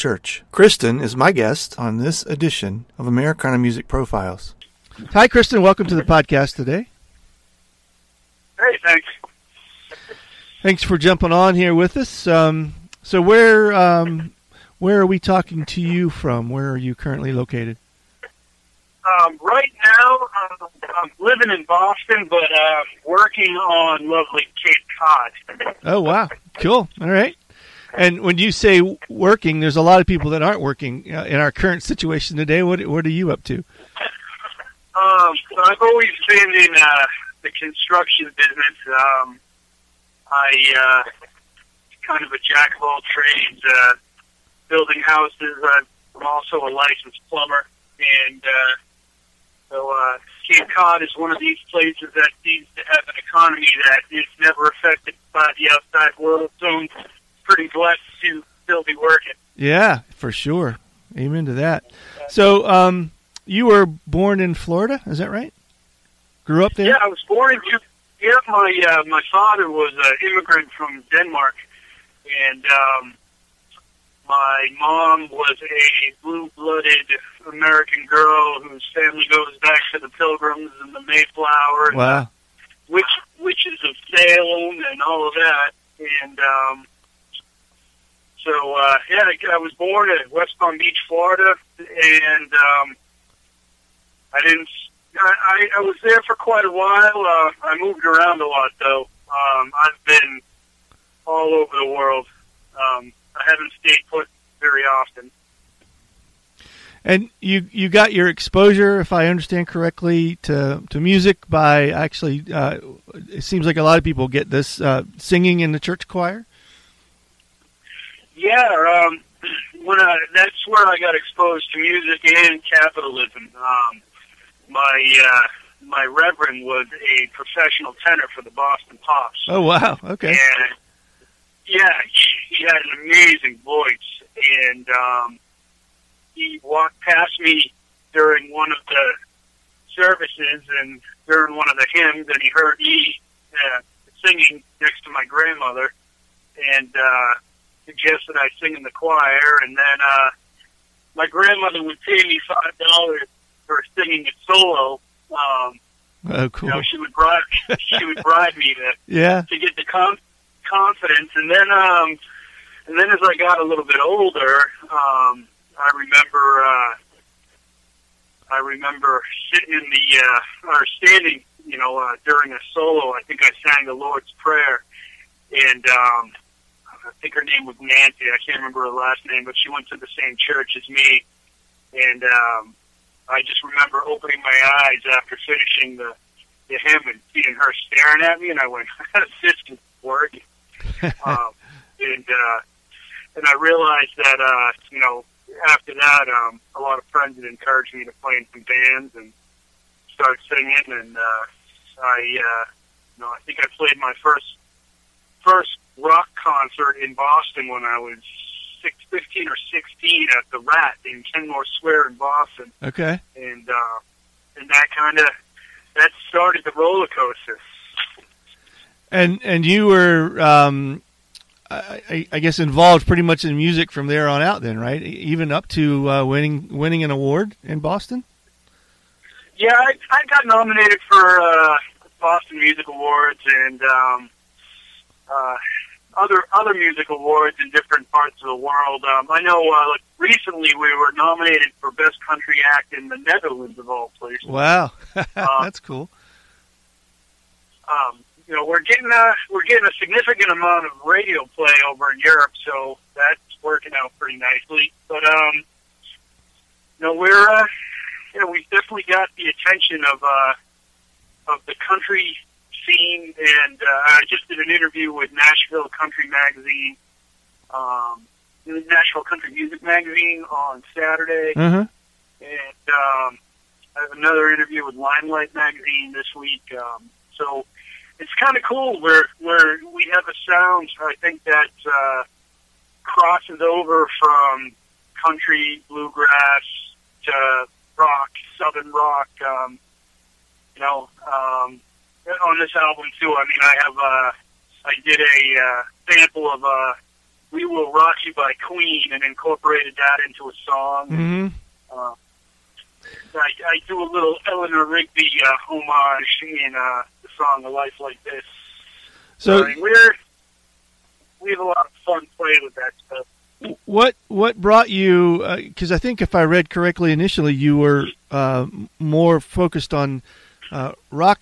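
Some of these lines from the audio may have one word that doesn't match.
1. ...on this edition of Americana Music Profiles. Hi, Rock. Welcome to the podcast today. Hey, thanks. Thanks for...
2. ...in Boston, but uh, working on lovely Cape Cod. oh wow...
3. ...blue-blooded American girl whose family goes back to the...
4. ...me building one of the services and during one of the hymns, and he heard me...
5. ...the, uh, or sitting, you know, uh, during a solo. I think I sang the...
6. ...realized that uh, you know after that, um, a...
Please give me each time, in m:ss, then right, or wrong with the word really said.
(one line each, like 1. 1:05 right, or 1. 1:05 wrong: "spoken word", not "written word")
1. 0:01 wrong: "Kristian", not "Rock"
2. 0:21 right
3. 1:16 right
4. 2:17 wrong: "during", not "building"
5. 2:49 wrong: "standing", not "sitting"
6. 3:13 right.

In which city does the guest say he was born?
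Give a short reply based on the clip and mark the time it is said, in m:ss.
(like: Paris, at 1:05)
West Palm Beach, at 1:30.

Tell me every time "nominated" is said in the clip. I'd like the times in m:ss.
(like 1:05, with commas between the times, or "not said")
3:50, 4:01.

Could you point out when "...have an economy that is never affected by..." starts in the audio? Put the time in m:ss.
0:52.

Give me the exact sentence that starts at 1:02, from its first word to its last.
So, um, you were born in Florida, is that right?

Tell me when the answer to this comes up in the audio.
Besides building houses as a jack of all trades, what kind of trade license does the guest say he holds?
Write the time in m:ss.
0:46.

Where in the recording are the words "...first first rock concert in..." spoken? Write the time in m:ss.
3:24.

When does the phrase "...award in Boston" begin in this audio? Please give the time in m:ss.
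3:47.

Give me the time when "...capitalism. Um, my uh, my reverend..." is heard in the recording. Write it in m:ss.
2:02.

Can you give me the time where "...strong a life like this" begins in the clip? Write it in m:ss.
5:07.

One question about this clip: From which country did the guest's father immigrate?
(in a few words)
Denmark.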